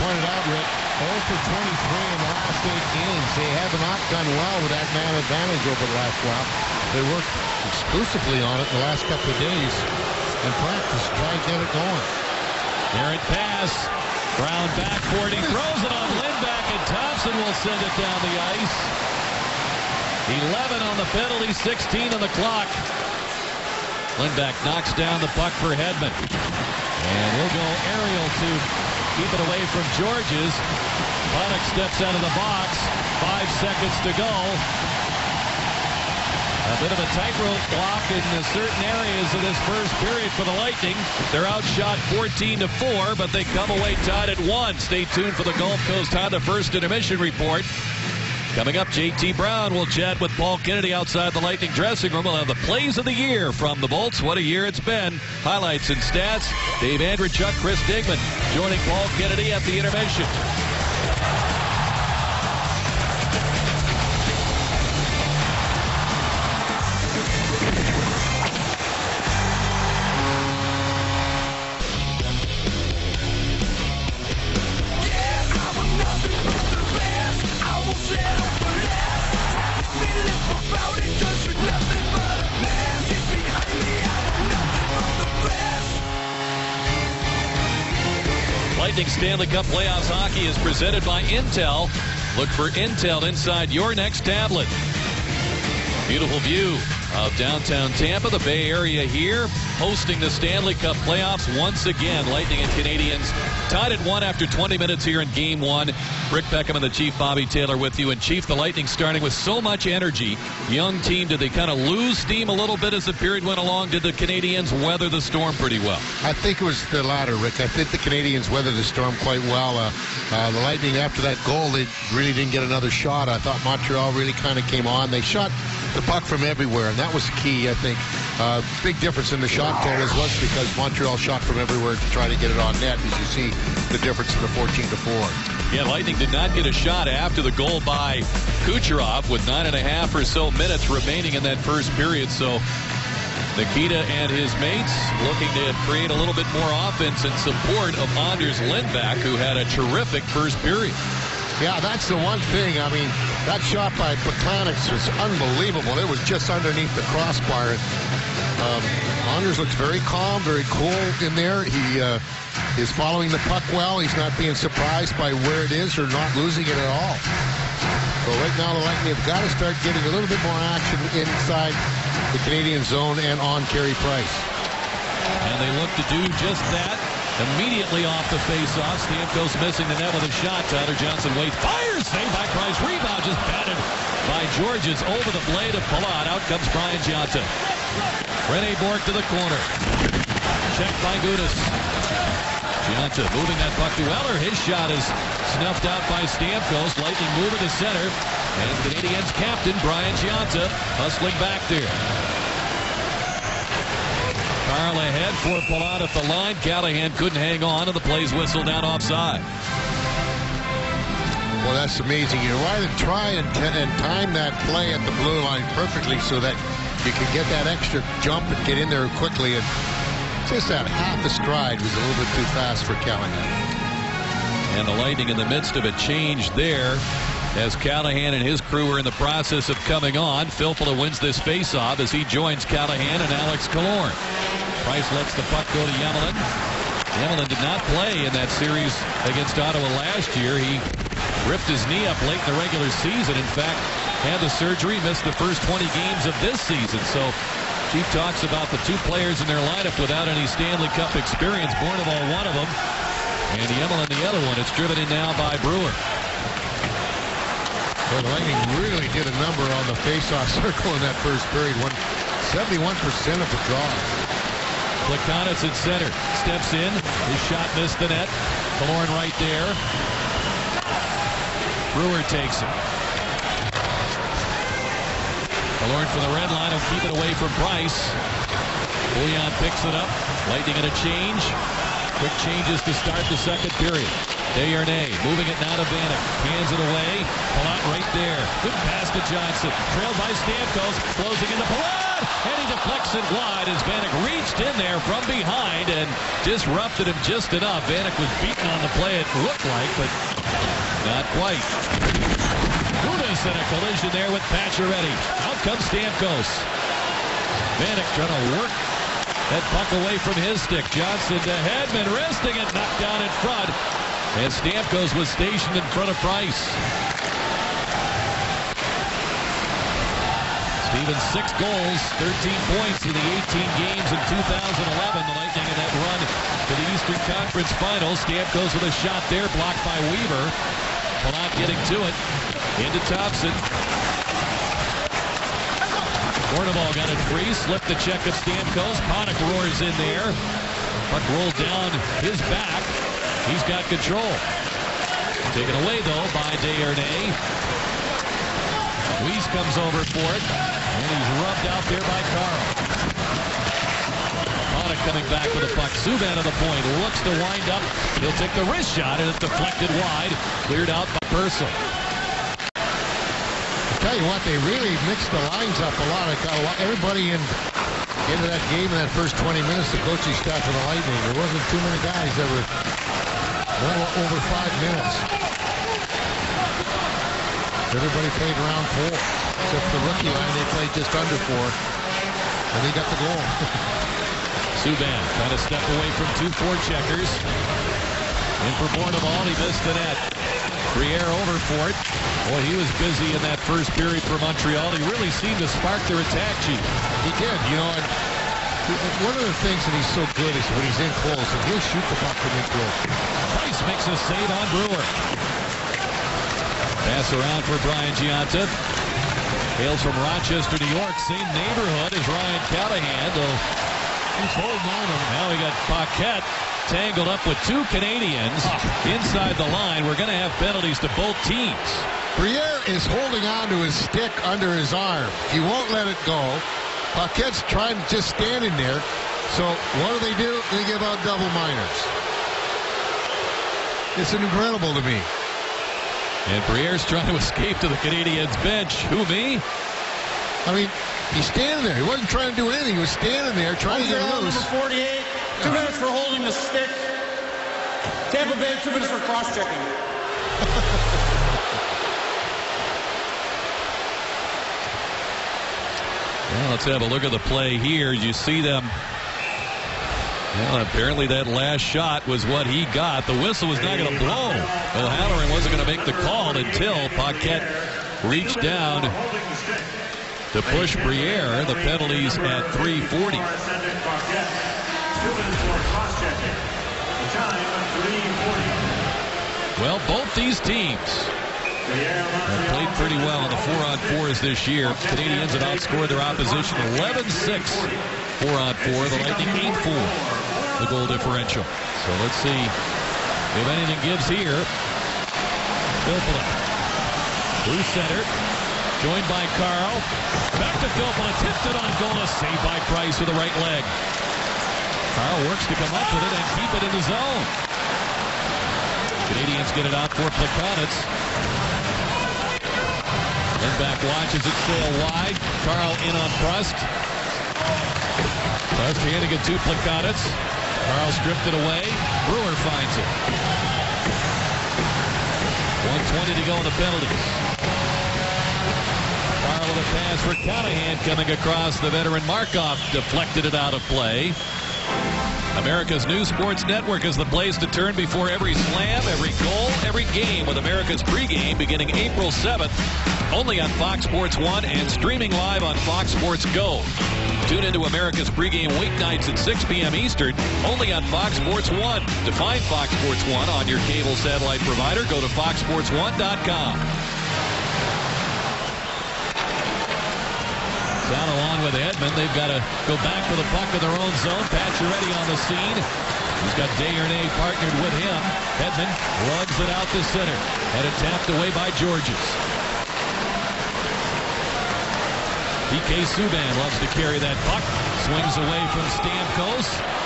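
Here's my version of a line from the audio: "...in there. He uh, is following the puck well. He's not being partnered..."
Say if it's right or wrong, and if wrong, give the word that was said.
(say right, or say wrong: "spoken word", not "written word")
wrong: "surprised", not "partnered".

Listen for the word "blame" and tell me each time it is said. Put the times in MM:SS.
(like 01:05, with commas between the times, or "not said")
not said.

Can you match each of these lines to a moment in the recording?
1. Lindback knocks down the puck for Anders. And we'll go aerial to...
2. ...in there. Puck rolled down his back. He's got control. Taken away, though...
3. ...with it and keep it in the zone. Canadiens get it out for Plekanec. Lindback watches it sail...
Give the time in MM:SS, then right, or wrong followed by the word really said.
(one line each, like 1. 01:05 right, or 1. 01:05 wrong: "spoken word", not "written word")
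1. 00:24 wrong: "Hedman", not "Anders"
2. 05:39 right
3. 08:26 right.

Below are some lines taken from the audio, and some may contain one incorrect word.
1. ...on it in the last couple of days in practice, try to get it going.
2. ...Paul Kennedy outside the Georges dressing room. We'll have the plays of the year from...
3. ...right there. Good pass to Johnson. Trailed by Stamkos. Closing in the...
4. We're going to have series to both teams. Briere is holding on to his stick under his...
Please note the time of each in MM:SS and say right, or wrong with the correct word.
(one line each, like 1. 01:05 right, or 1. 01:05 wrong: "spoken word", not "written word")
1. 00:08 right
2. 00:50 wrong: "Lightning", not "Georges"
3. 04:47 right
4. 07:00 wrong: "penalties", not "series".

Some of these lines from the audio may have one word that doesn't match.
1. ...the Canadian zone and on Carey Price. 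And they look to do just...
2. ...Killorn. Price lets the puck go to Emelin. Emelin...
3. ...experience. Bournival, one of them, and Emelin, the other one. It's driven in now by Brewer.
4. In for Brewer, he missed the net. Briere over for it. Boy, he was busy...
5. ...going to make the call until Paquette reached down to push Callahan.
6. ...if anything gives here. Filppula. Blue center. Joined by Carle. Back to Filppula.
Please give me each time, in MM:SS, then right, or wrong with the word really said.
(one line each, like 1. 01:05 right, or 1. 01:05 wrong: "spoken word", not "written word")
1. 02:52 right
2. 03:53 right
3. 04:11 right
4. 06:28 wrong: "Bournival", not "Brewer"
5. 07:45 wrong: "Briere", not "Callahan"
6. 08:12 right.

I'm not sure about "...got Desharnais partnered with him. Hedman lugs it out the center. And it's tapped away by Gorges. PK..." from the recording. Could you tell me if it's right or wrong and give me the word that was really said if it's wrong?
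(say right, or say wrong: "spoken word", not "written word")
right.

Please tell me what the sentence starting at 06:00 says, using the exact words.
Cleared out by Purcell tell you what, they really mixed the lines up a lot.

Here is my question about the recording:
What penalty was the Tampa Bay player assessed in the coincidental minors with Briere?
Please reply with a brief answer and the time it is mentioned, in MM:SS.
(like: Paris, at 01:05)
Cross-checking, at 07:29.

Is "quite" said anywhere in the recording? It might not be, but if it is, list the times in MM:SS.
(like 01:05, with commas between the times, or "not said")
01:59, 05:01.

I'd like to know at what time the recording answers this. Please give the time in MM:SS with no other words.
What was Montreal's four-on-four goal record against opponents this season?
08:06.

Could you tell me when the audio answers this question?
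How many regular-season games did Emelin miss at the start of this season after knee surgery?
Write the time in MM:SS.
04:05.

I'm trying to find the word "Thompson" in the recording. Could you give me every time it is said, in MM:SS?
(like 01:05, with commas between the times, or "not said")
00:16, 05:33.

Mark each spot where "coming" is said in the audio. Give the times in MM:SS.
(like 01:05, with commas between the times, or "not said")
00:48, 03:49, 05:55, 08:51.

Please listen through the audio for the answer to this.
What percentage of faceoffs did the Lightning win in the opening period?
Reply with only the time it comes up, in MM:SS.
04:22.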